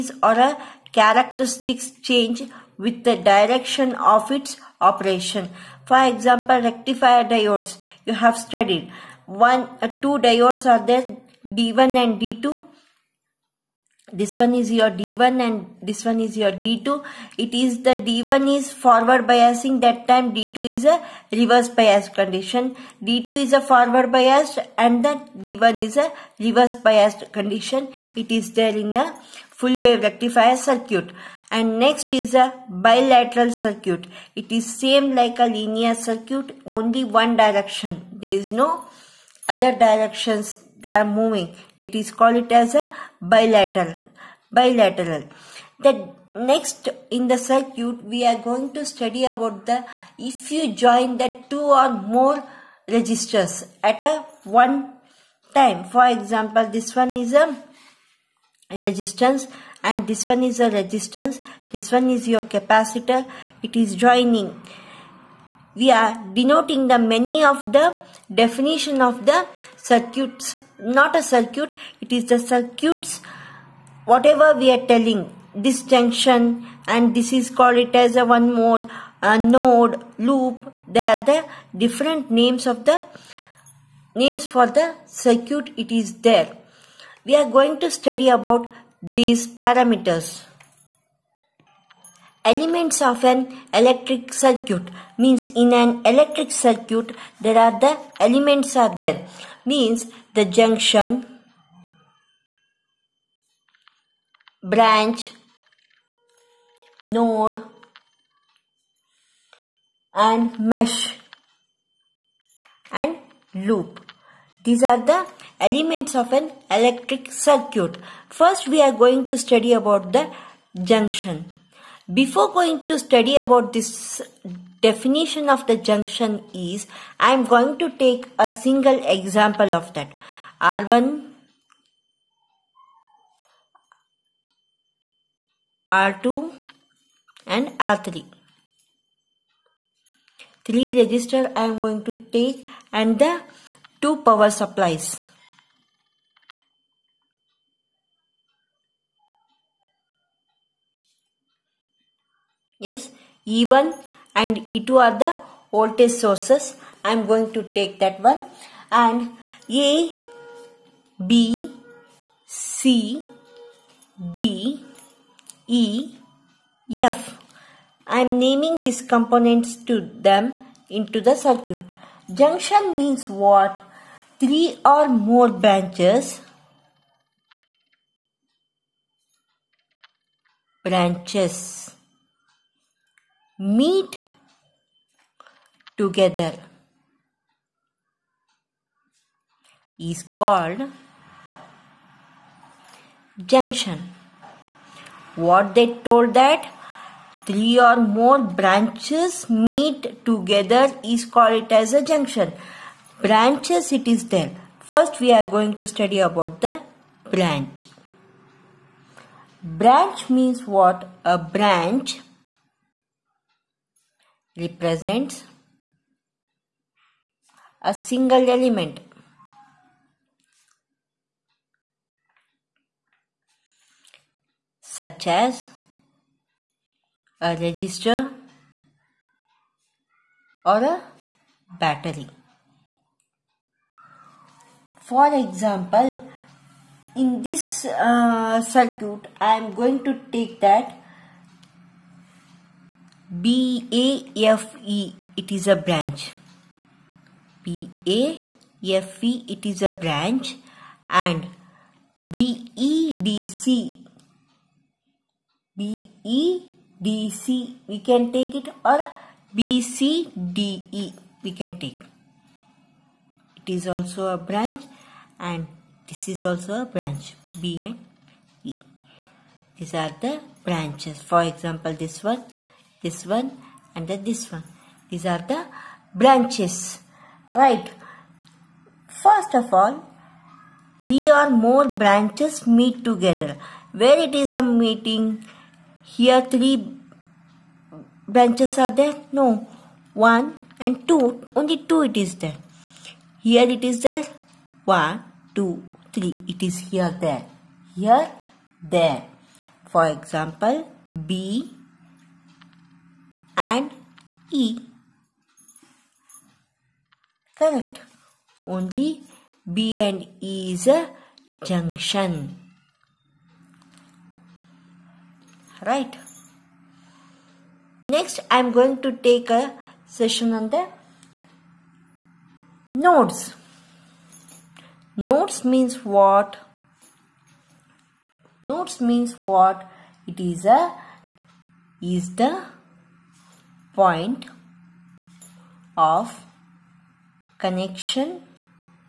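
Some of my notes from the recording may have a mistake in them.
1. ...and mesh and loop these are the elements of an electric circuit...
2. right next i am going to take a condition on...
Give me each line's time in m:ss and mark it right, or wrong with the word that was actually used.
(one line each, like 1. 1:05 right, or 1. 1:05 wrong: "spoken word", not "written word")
1. 1:50 right
2. 5:15 wrong: "session", not "condition".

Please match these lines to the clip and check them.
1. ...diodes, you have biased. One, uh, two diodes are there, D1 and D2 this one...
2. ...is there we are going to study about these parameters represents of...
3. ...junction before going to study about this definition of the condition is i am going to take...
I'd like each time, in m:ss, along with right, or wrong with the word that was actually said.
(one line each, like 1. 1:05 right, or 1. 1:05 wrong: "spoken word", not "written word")
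1. 0:07 wrong: "studied", not "biased"
2. 1:25 wrong: "elements", not "represents"
3. 2:00 wrong: "junction", not "condition".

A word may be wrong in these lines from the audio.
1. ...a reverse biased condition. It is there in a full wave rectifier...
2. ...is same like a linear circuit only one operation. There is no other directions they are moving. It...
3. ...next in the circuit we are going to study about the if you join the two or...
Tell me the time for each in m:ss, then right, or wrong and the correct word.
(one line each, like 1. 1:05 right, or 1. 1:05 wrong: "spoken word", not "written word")
1. 0:25 right
2. 0:34 wrong: "direction", not "operation"
3. 0:46 right.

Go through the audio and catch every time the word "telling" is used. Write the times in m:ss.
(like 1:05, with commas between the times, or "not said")
1:14.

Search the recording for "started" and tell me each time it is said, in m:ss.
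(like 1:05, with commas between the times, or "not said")
not said.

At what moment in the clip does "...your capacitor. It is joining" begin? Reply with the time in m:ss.
1:02.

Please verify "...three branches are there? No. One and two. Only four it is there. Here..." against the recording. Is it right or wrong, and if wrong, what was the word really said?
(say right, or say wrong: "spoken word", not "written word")
wrong: "two", not "four".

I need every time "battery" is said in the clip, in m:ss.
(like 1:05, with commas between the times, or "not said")
3:51.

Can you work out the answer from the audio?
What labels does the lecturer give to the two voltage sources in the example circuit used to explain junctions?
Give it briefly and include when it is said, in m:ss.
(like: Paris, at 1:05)
E1 and E2, at 2:33.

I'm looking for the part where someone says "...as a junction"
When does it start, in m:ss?
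3:21.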